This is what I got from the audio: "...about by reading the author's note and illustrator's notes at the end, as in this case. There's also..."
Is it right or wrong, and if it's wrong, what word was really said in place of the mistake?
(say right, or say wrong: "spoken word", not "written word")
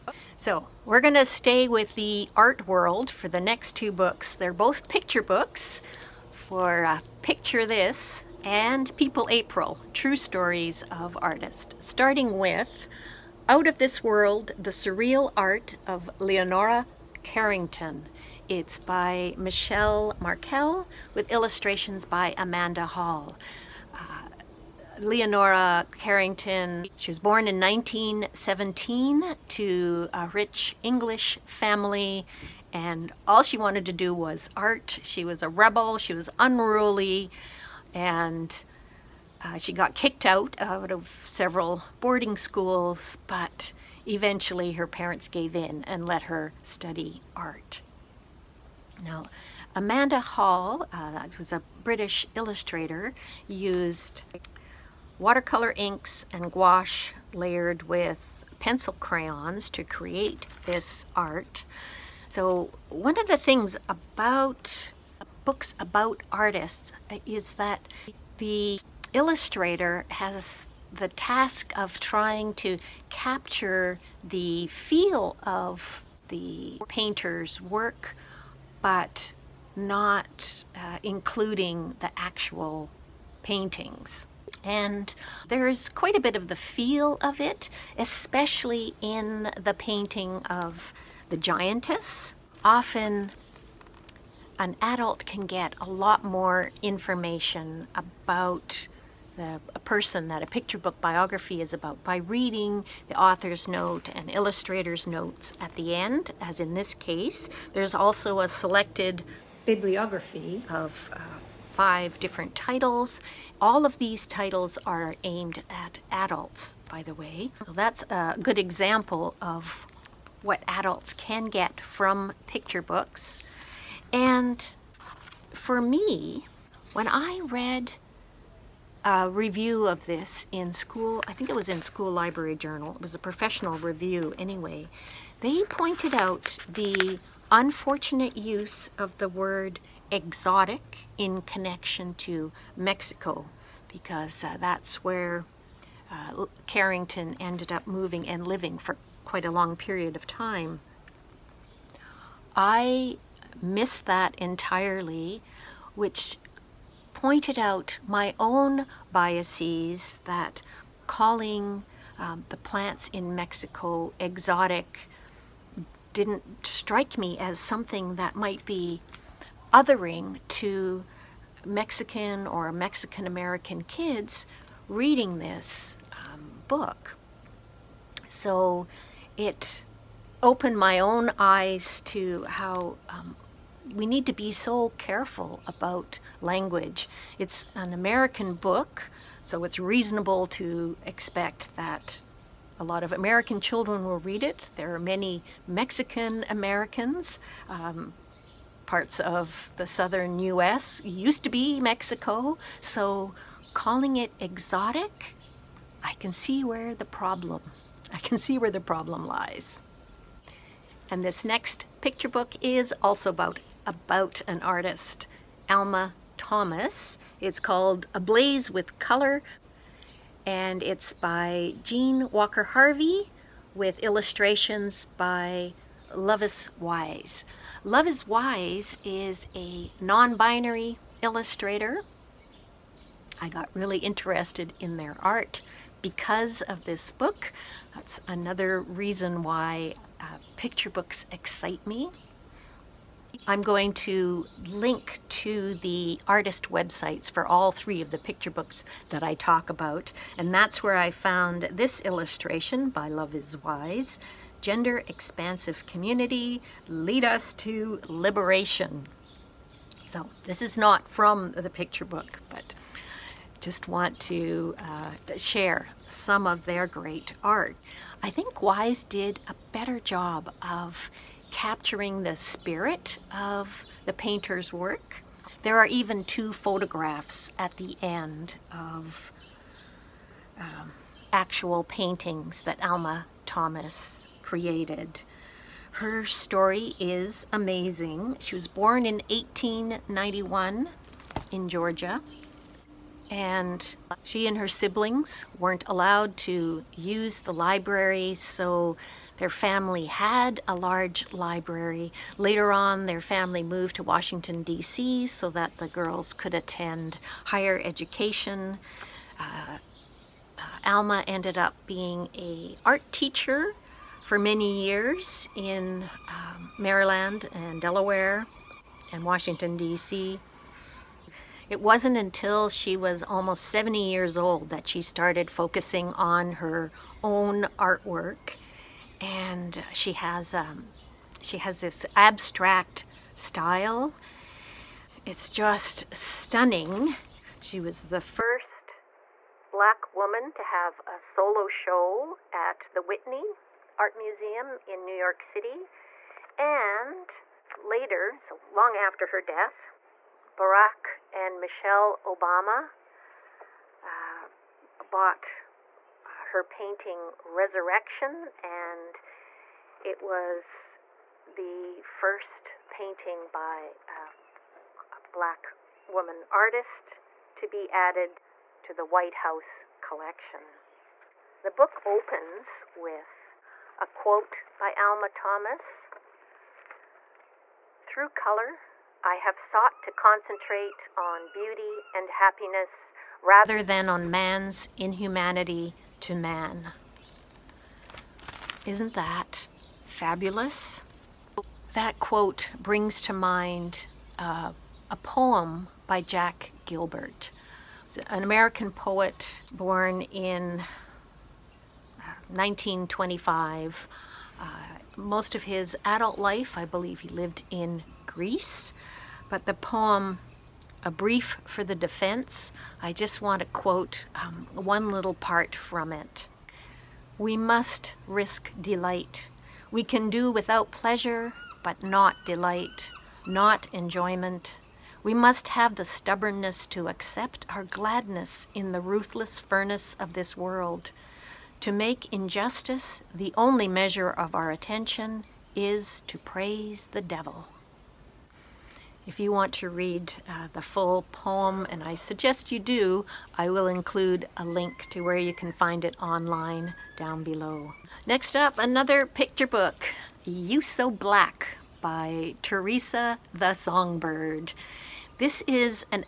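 right.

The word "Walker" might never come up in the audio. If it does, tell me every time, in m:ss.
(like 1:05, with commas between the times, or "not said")
3:42.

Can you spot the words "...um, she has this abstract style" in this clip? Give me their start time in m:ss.
5:30.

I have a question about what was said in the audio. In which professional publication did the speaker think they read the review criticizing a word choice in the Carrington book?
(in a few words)
School Library Journal.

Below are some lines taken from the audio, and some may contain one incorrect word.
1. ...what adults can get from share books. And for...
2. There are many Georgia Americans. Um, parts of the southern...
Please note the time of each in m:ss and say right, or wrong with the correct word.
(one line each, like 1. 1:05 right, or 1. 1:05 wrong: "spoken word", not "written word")
1. 2:00 wrong: "picture", not "share"
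2. 3:14 wrong: "Mexican", not "Georgia".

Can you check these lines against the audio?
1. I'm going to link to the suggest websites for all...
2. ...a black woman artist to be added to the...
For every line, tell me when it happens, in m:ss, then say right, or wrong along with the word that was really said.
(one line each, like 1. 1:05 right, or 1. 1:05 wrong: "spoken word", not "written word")
1. 4:03 wrong: "artist", not "suggest"
2. 6:04 right.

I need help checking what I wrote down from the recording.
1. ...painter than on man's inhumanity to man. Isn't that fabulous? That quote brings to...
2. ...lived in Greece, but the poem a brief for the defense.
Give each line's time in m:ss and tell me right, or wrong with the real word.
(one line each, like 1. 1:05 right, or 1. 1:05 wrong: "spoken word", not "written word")
1. 6:23 wrong: "rather", not "painter"
2. 6:47 right.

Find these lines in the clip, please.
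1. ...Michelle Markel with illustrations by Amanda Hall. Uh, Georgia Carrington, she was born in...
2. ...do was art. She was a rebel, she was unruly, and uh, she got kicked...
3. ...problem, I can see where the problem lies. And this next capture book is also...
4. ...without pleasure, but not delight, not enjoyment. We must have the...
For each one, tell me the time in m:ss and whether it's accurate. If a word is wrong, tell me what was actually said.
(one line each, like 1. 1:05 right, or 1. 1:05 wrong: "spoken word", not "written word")
1. 0:19 wrong: "Leonora", not "Georgia"
2. 0:33 right
3. 3:27 wrong: "picture", not "capture"
4. 7:00 right.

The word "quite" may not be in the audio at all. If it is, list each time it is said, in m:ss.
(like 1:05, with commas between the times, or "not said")
1:25, 2:29.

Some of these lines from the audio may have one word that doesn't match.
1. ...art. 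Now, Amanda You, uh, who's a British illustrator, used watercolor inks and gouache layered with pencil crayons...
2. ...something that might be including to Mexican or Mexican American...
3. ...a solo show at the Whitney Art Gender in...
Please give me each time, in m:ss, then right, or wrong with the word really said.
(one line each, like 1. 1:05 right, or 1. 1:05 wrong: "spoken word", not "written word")
1. 0:47 wrong: "Hall", not "You"
2. 2:47 wrong: "othering", not "including"
3. 5:41 wrong: "Museum", not "Gender".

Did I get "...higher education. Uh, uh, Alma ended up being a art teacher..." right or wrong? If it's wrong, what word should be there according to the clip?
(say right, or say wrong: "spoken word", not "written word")
right.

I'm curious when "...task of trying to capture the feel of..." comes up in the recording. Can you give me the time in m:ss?
1:11.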